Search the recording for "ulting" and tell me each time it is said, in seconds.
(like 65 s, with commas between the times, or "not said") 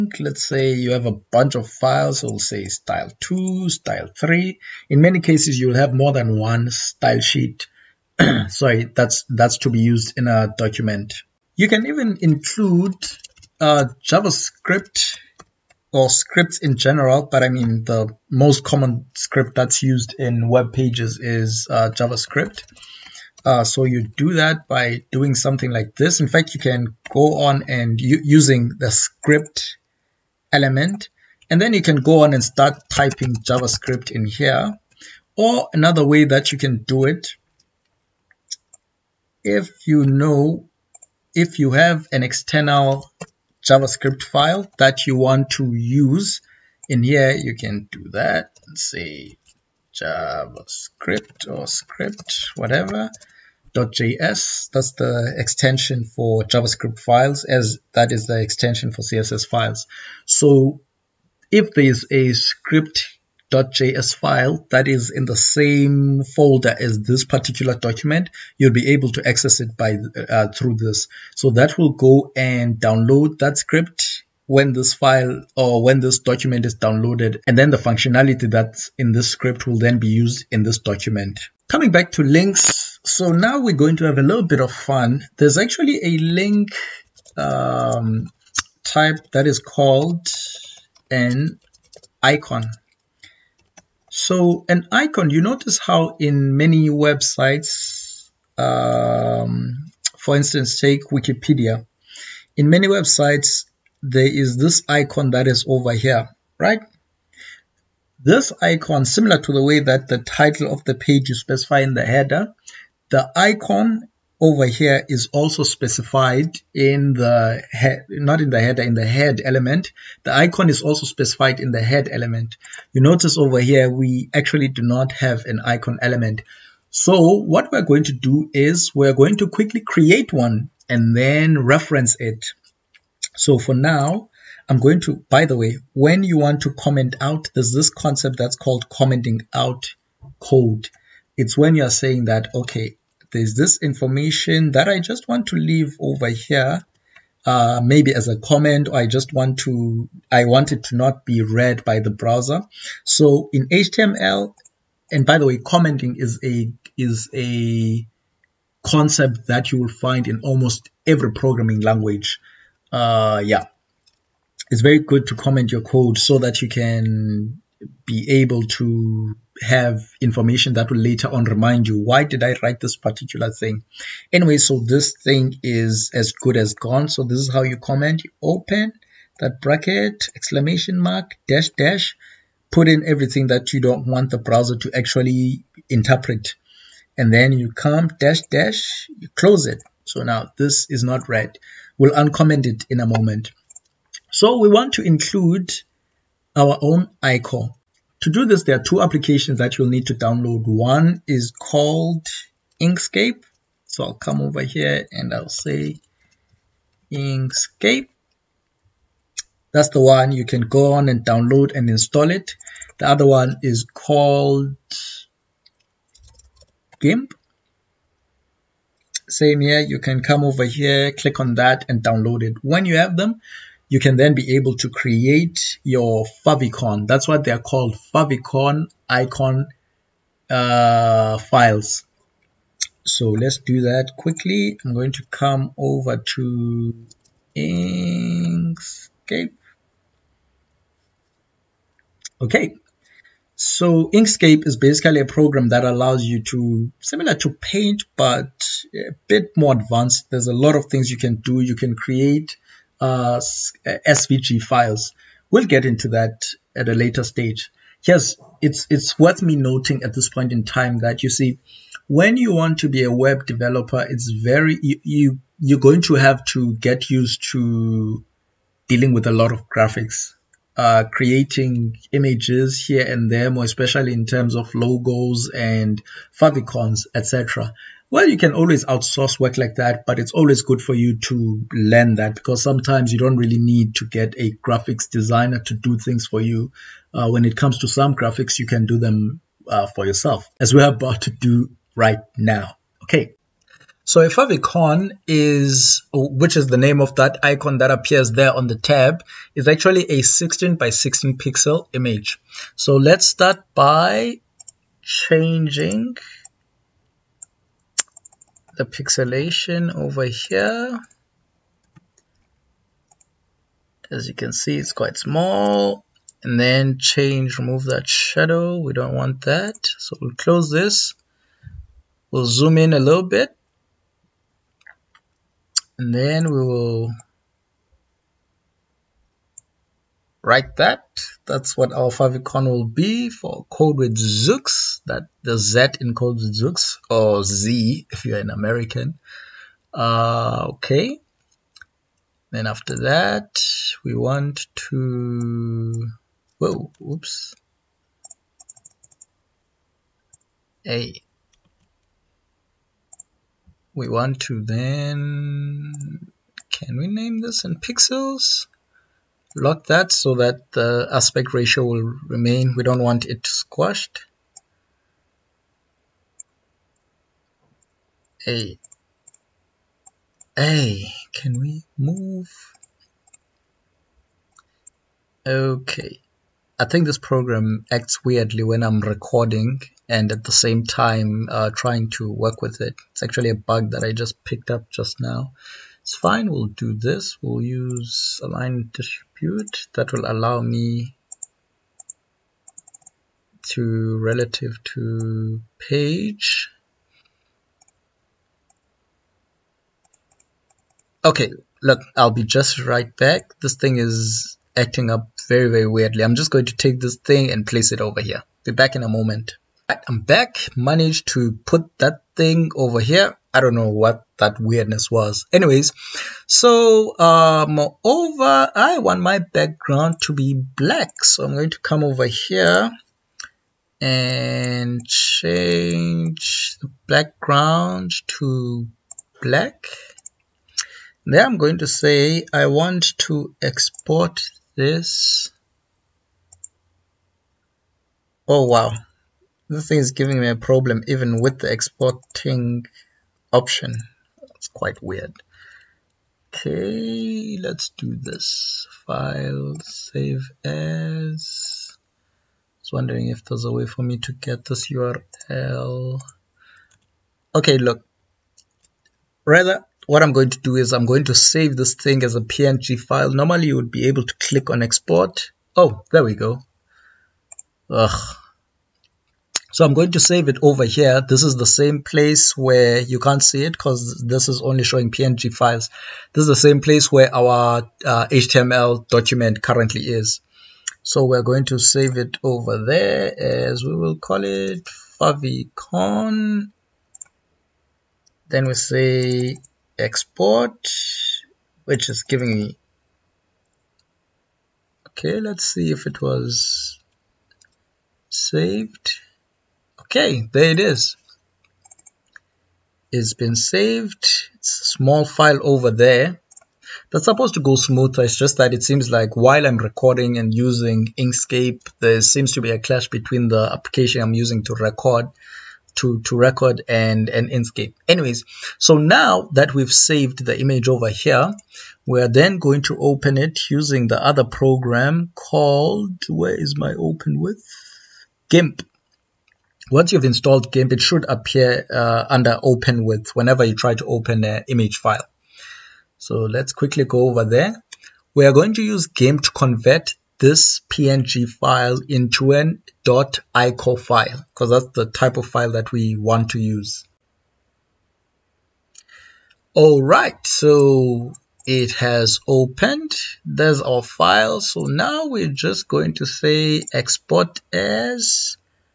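not said.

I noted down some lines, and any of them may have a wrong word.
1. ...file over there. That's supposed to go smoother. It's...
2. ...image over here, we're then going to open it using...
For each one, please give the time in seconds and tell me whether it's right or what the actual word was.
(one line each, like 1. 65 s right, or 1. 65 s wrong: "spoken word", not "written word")
1. 505 s right
2. 520 s right.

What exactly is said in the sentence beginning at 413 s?
I don't know what that weirdness was.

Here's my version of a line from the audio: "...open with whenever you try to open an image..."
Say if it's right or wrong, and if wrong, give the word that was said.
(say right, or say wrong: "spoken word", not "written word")
right.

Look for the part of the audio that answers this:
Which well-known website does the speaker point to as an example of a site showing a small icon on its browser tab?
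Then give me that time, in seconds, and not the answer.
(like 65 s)
101 s.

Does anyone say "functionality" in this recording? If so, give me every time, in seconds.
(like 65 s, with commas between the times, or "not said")
77 s.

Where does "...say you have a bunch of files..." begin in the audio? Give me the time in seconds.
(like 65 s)
0 s.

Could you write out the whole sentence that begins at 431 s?
Then I'm going to say I want to export this.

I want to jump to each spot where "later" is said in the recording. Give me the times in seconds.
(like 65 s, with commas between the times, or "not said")
170 s, 256 s.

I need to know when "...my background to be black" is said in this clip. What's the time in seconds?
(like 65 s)
419 s.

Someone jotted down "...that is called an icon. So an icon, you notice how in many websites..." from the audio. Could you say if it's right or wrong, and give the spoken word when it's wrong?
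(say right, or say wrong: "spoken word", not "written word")
right.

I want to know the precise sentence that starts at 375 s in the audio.
Okay, I think this program acts weirdly when I'm recording and at the same time uh, trying to work with it.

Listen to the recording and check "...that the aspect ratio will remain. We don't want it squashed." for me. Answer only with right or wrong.
right.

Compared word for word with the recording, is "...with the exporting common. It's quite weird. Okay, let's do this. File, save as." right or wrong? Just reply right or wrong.
wrong.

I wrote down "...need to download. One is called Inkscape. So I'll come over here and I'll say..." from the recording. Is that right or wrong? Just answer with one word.
right.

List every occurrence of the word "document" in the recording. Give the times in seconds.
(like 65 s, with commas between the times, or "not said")
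10 s, 67 s, 76 s, 80 s, 479 s.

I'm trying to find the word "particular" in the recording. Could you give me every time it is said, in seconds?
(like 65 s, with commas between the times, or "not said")
67 s, 172 s.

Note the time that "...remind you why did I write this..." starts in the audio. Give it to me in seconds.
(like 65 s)
171 s.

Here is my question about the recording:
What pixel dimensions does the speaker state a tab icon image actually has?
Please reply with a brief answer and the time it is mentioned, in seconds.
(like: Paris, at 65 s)
16 by 16, at 300 s.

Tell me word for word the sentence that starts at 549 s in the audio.
All right, so it has opened.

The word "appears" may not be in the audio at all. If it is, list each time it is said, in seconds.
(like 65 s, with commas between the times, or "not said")
297 s, 531 s.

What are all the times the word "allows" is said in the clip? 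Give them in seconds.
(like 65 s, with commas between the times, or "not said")
245 s, 390 s.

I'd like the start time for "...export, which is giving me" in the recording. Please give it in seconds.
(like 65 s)
489 s.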